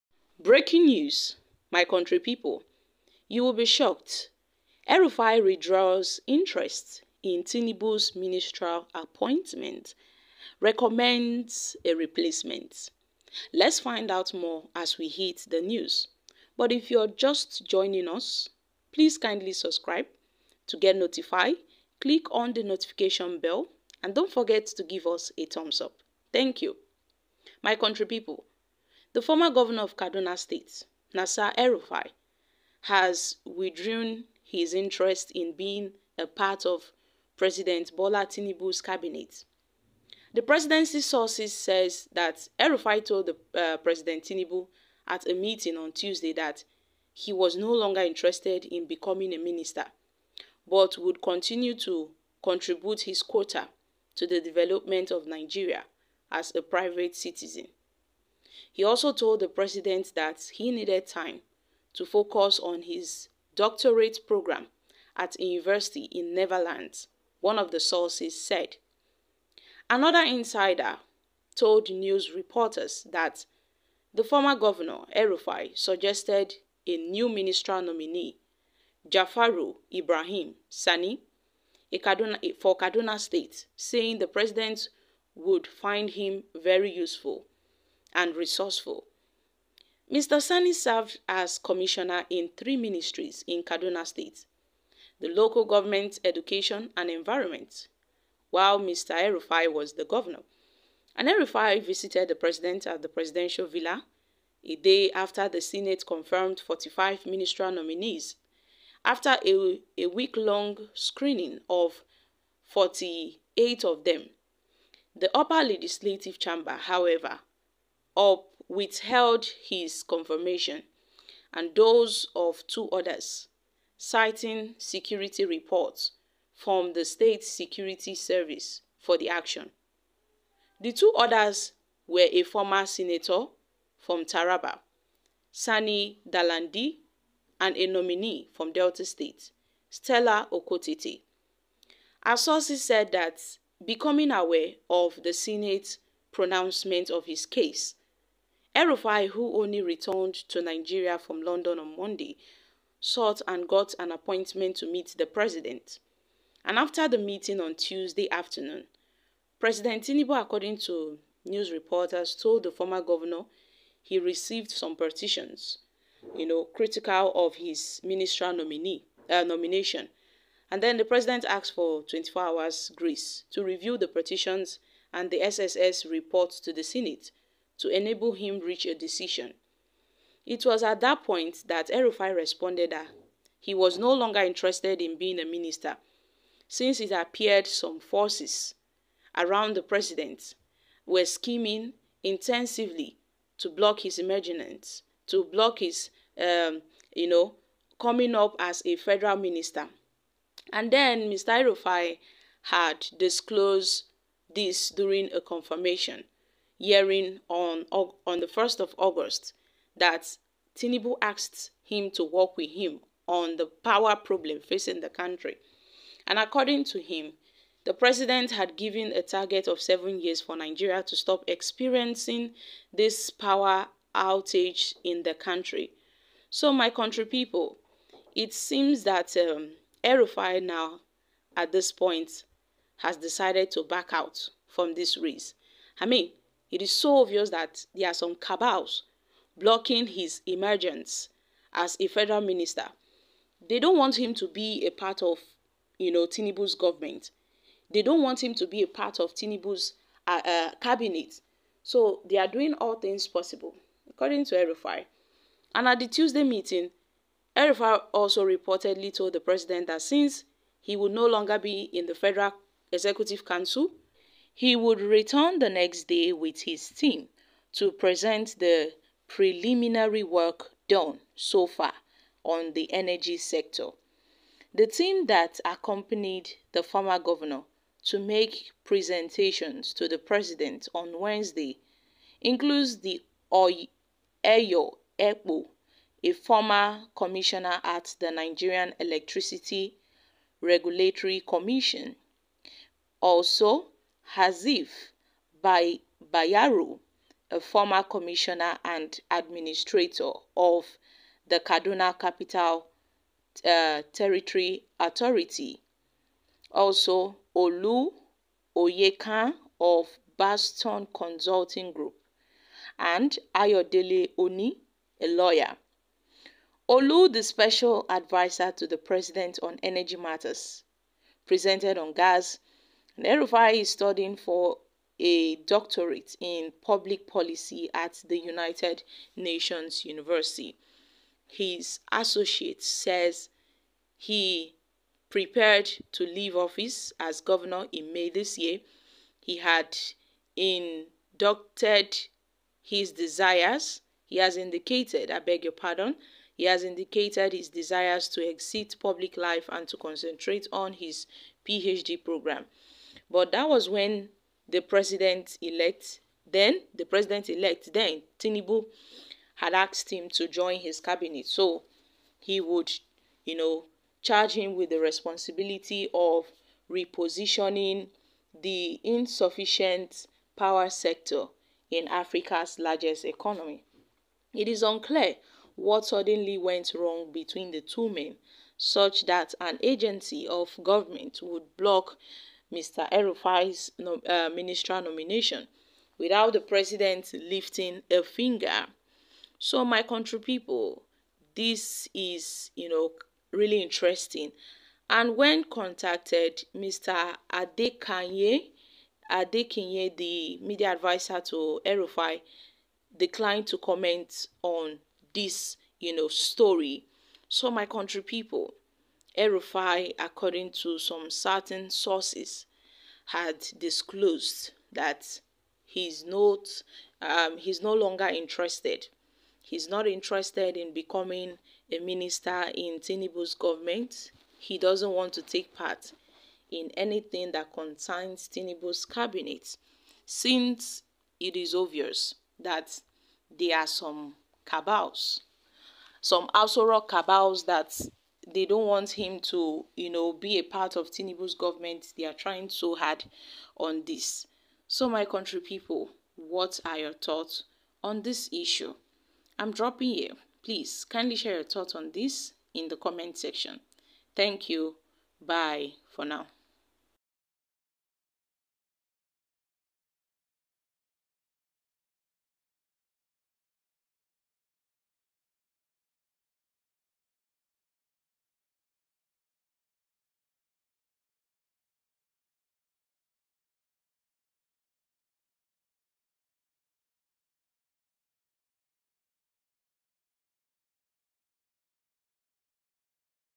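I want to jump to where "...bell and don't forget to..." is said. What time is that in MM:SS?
00:23.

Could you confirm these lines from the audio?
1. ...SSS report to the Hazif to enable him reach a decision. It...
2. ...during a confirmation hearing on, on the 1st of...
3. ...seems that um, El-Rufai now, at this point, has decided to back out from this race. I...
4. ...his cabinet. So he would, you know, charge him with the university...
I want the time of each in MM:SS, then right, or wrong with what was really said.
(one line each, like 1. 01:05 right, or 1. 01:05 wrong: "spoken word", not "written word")
1. 02:55 wrong: "Senate", not "Hazif"
2. 03:24 right
3. 03:48 right
4. 06:00 wrong: "responsibility", not "university".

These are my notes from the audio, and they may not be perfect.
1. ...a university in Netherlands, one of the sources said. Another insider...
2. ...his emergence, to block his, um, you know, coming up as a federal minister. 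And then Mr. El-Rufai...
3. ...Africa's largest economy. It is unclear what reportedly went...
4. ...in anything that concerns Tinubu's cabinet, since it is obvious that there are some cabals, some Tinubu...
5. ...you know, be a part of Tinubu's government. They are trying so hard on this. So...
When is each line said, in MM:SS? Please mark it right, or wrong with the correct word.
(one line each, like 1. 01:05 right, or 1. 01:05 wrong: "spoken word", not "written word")
1. 01:05 right
2. 03:14 right
3. 06:12 wrong: "suddenly", not "reportedly"
4. 07:06 wrong: "Aso", not "Tinubu"
5. 07:19 right.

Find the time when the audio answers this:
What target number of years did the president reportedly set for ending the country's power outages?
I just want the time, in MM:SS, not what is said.
03:39.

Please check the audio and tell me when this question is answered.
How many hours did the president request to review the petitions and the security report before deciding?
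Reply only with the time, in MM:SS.
02:52.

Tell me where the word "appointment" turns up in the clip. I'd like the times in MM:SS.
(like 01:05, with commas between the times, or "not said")
00:08, 02:34.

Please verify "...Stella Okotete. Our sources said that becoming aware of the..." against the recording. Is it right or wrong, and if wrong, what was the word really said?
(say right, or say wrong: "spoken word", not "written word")
right.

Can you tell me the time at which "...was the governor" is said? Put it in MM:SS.
01:39.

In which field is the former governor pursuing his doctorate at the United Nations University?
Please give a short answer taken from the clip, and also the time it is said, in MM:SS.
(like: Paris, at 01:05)
Public policy, at 05:26.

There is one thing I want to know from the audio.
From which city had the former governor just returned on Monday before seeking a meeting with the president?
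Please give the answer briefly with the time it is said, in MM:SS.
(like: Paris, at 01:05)
London, at 02:31.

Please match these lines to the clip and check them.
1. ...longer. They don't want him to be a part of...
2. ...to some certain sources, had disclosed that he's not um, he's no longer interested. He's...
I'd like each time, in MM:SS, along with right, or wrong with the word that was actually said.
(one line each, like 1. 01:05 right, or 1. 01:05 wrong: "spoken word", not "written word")
1. 04:02 wrong: "minister", not "longer"
2. 06:50 right.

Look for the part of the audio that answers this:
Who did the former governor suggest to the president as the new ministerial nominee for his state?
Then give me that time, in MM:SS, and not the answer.
01:19.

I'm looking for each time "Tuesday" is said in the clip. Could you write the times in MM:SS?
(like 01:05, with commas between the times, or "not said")
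00:45, 02:37, 04:16.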